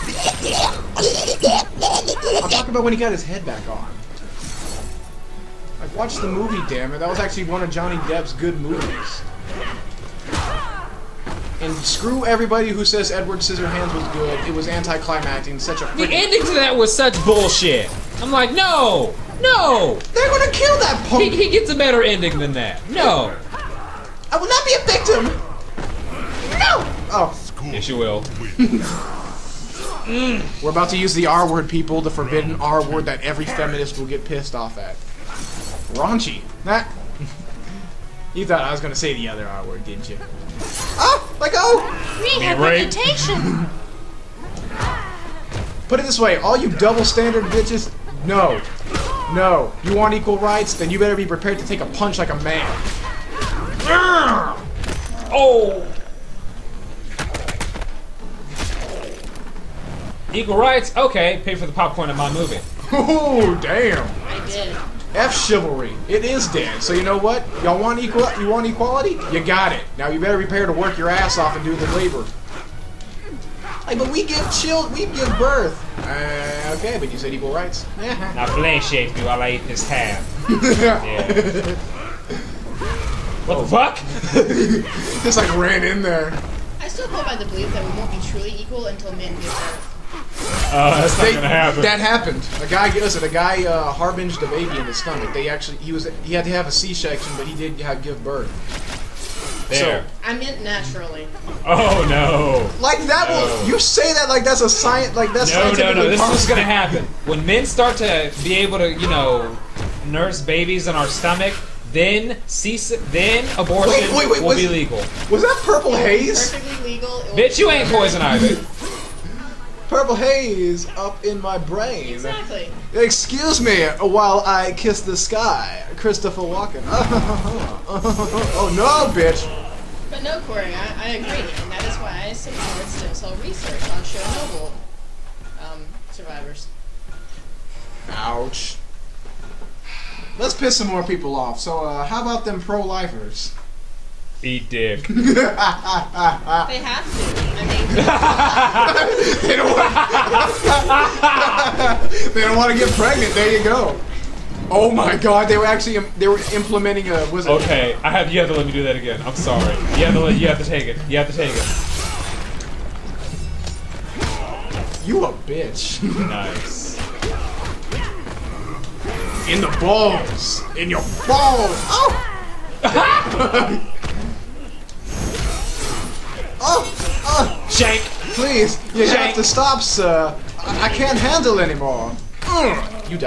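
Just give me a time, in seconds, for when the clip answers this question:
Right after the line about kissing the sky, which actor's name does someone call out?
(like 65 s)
125 s.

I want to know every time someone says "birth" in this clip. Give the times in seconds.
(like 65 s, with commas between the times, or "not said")
75 s, 89 s, 98 s.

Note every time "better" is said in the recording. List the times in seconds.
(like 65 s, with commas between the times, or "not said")
21 s, 51 s, 70 s.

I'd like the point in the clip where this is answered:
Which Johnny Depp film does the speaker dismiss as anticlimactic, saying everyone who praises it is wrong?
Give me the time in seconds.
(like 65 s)
13 s.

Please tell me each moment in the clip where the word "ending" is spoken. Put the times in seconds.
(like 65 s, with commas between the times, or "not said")
16 s, 22 s.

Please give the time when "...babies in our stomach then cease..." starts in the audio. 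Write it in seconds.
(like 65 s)
110 s.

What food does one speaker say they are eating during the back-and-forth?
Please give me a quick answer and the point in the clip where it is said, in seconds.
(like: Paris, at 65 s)
Ham, at 79 s.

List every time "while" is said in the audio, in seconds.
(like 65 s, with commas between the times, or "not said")
79 s, 124 s.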